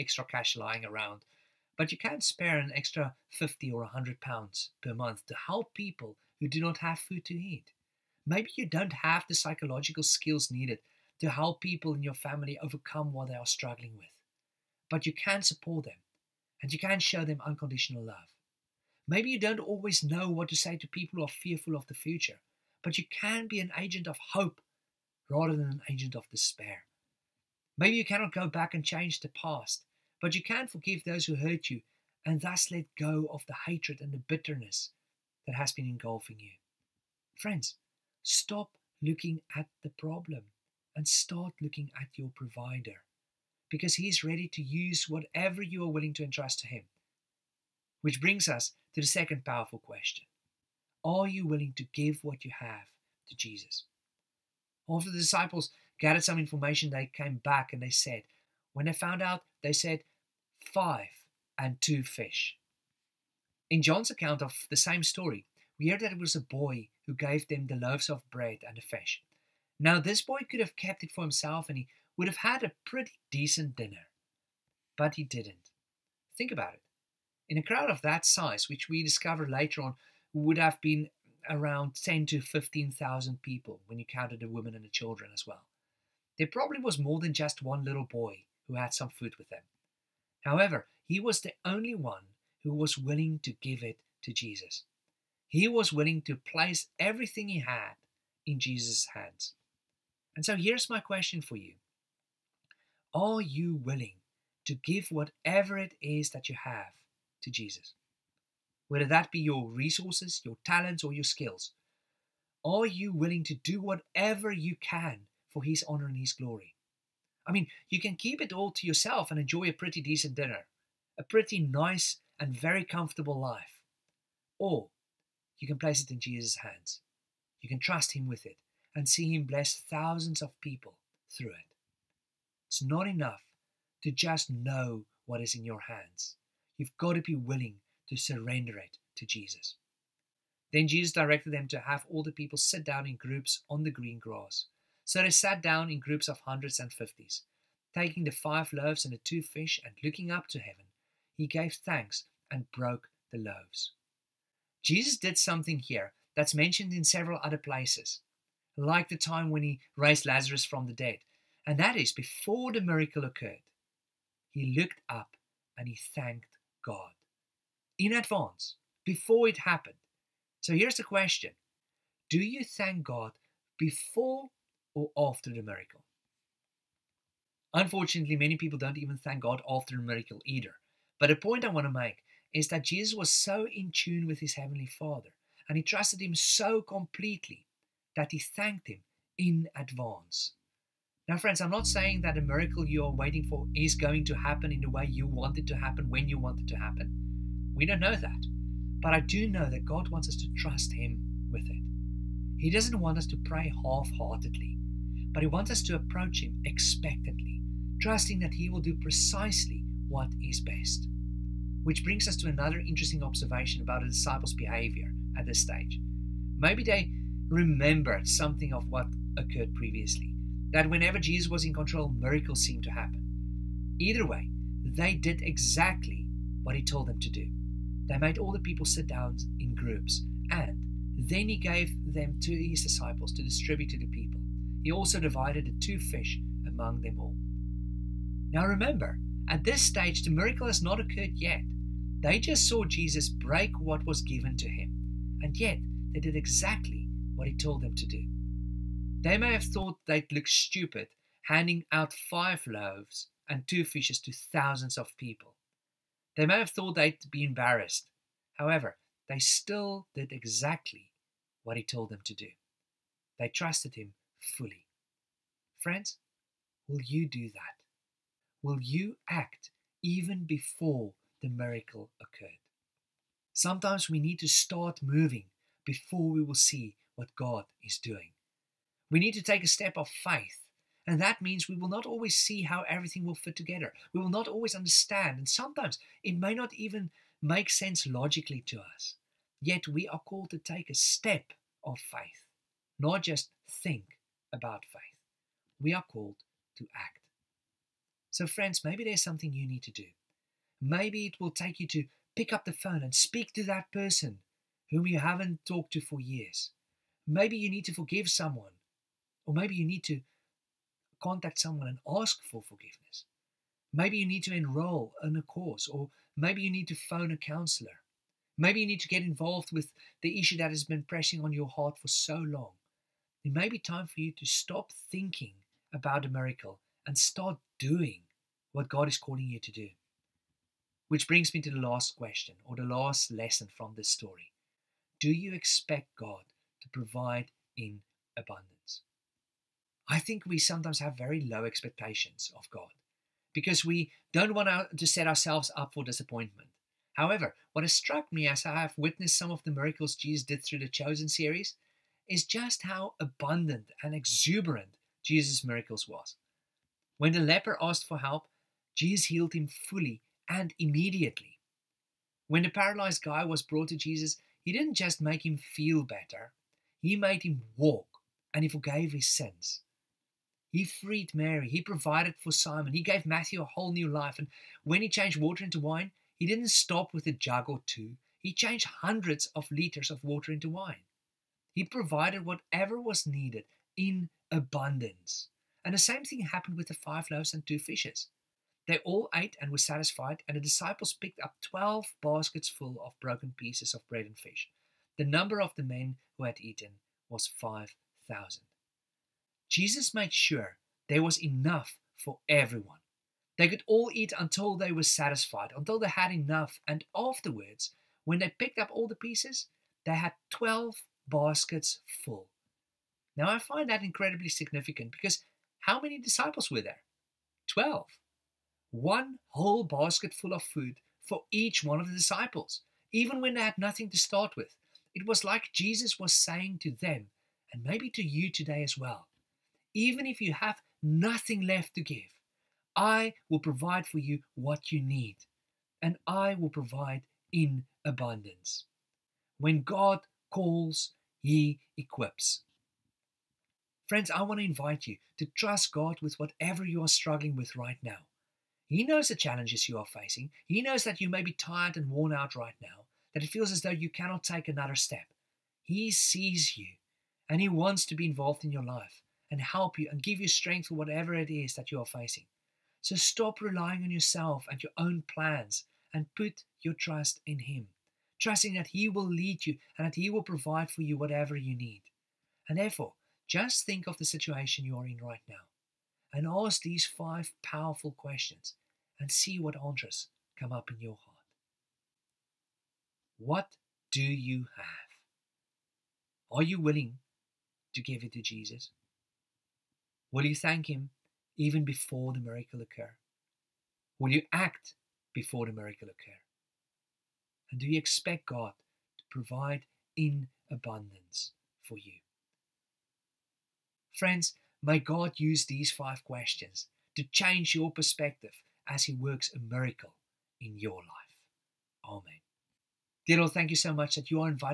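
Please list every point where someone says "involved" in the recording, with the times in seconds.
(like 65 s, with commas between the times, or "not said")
319 s, 458 s.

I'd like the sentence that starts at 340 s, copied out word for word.
I think we sometimes have very low expectations of God because we don't want to set ourselves up for disappointment.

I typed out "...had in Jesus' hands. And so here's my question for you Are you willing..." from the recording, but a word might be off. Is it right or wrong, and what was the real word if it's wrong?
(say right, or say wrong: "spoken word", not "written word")
right.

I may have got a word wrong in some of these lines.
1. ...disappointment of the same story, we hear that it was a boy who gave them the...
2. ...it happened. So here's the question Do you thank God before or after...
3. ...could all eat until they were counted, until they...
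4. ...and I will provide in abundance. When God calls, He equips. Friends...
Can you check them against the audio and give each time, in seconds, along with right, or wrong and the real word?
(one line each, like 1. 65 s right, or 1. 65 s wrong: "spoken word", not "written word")
1. 64 s wrong: "account", not "disappointment"
2. 169 s right
3. 403 s wrong: "satisfied", not "counted"
4. 436 s right.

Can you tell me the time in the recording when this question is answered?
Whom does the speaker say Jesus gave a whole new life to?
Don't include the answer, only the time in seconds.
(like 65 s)
373 s.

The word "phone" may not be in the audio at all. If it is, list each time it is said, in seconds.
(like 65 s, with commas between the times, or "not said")
302 s, 316 s.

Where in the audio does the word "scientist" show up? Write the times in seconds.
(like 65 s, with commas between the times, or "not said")
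not said.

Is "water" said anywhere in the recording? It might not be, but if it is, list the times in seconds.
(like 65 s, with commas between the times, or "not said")
375 s, 380 s.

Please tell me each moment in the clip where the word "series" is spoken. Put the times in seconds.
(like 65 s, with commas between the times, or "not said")
351 s.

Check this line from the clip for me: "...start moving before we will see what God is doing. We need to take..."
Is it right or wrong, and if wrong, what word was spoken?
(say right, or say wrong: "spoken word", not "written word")
right.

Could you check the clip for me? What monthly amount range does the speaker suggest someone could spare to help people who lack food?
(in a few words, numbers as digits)
50 or 100 pounds.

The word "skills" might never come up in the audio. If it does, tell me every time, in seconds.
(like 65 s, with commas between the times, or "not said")
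10 s, 111 s.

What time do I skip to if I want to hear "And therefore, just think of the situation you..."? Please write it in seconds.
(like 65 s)
472 s.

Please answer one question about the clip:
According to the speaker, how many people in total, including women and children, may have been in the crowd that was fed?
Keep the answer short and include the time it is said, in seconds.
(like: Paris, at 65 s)
10 to 15,000, at 82 s.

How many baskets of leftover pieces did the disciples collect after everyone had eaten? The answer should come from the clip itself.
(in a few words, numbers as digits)
12.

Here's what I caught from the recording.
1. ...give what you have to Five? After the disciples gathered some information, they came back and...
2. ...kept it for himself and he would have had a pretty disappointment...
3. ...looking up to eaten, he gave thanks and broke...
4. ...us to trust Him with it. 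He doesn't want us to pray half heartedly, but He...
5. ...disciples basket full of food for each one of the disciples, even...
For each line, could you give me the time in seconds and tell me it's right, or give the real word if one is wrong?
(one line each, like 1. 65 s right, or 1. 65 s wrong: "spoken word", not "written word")
1. 51 s wrong: "Jesus", not "Five"
2. 70 s wrong: "decent", not "disappointment"
3. 150 s wrong: "heaven", not "eaten"
4. 200 s right
5. 419 s wrong: "whole", not "disciples".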